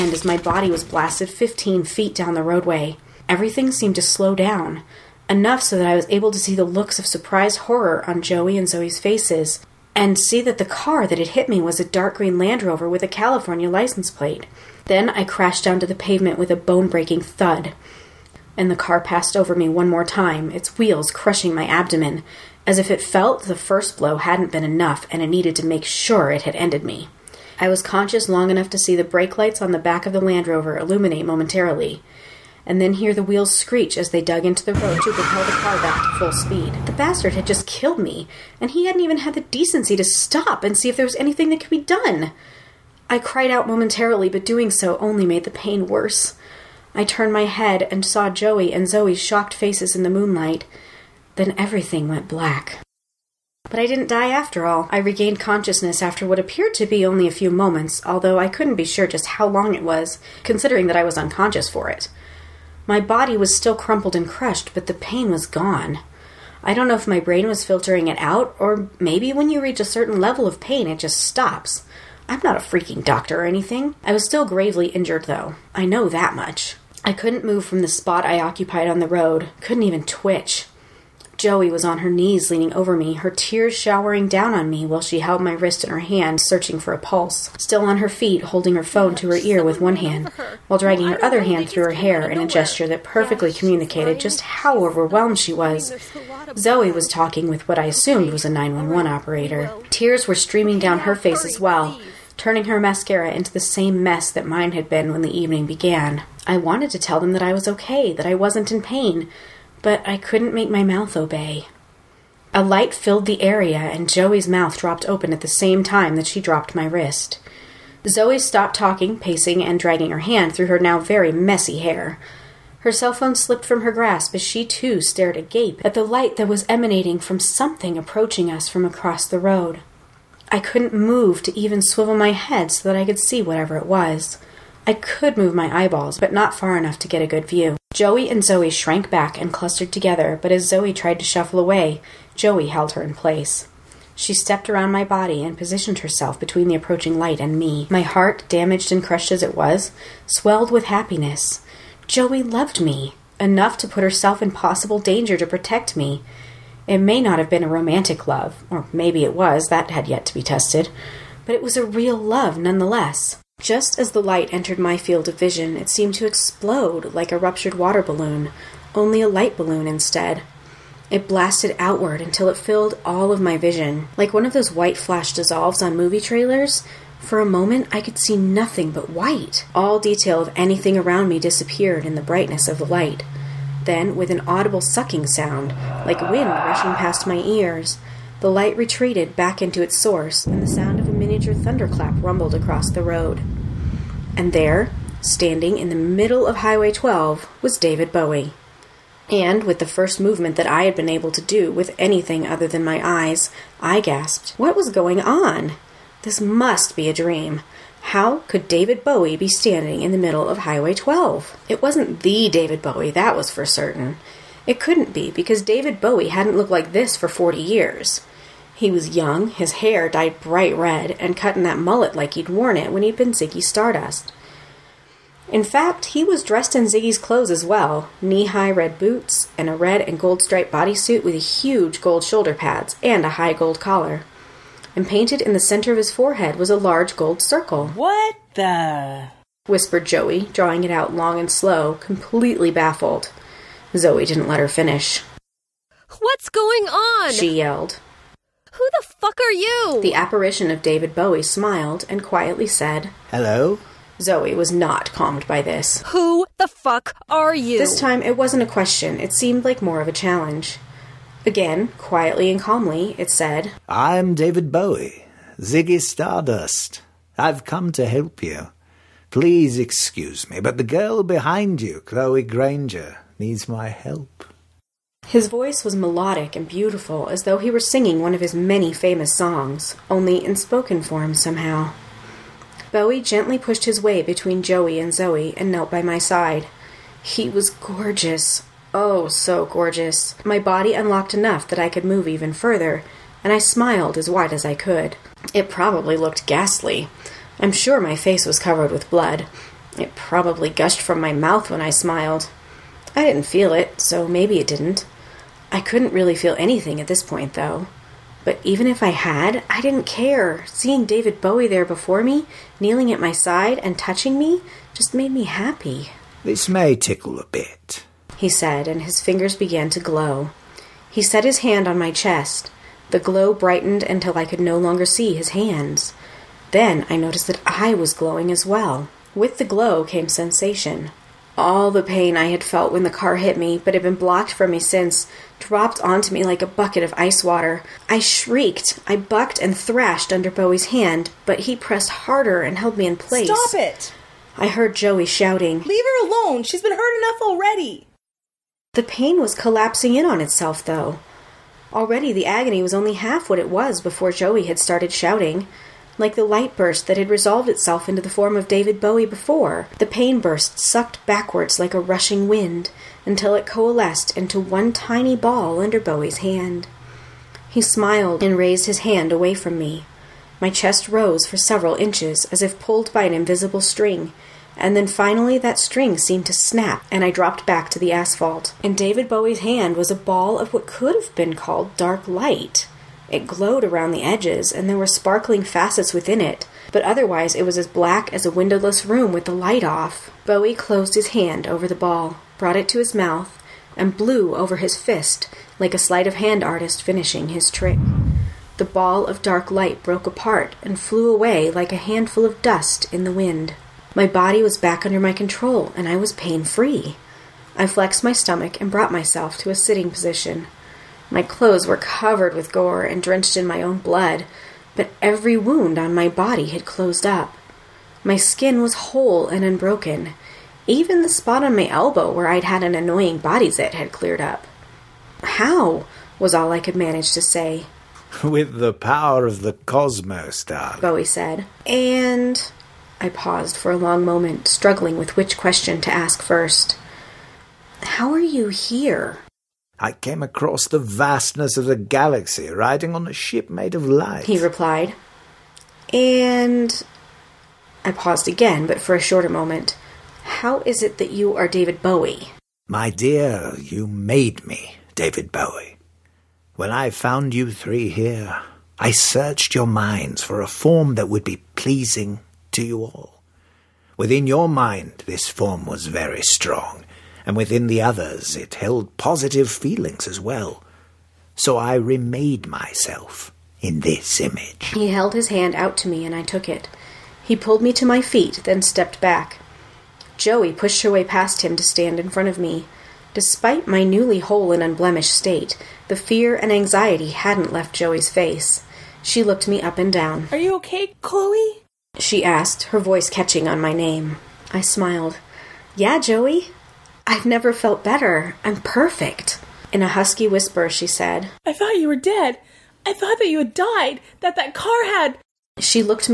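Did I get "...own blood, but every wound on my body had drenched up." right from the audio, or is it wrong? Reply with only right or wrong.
wrong.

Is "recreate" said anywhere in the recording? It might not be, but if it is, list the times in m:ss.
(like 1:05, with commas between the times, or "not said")
not said.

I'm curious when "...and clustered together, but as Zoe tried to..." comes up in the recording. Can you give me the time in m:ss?
2:19.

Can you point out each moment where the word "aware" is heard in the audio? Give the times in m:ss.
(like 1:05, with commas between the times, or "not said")
not said.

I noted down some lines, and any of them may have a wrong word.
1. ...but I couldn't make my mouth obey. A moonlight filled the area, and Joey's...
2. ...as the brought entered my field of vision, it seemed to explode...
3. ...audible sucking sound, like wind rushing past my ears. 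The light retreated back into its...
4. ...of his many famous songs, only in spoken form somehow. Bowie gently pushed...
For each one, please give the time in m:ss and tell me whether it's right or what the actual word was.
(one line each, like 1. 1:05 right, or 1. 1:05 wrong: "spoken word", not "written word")
1. 1:49 wrong: "light", not "moonlight"
2. 2:43 wrong: "light", not "brought"
3. 3:04 right
4. 4:38 right.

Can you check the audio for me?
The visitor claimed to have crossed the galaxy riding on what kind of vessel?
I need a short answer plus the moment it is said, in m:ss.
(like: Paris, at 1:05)
A ship made of light, at 7:23.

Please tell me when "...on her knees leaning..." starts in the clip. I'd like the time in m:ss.
1:21.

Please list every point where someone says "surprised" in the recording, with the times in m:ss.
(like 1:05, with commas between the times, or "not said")
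0:07.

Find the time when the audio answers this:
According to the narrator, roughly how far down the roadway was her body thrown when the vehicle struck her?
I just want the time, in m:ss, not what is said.
0:01.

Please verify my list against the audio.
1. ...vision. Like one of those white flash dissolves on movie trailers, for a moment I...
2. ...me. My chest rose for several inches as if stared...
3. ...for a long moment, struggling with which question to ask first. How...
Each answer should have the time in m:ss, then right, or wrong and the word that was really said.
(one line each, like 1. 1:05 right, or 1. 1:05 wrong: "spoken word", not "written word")
1. 2:53 right
2. 6:09 wrong: "pulled", not "stared"
3. 7:13 right.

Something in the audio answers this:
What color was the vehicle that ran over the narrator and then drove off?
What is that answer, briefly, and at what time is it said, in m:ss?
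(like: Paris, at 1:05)
Dark green, at 0:11.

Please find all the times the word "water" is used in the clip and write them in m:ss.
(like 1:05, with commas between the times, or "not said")
2:47, 5:37.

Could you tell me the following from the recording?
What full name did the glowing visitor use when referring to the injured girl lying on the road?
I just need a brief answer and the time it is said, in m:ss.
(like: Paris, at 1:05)
Chloe Granger, at 4:32.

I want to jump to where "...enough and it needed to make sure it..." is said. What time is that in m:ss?
0:24.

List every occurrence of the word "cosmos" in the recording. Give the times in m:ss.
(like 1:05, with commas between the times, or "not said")
7:09.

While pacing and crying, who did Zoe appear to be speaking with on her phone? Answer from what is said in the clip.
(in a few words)
911 operator.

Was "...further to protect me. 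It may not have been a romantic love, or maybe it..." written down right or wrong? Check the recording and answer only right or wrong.
wrong.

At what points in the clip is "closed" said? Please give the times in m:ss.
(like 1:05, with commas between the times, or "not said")
6:30, 6:56.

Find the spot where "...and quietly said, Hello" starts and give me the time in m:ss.
4:12.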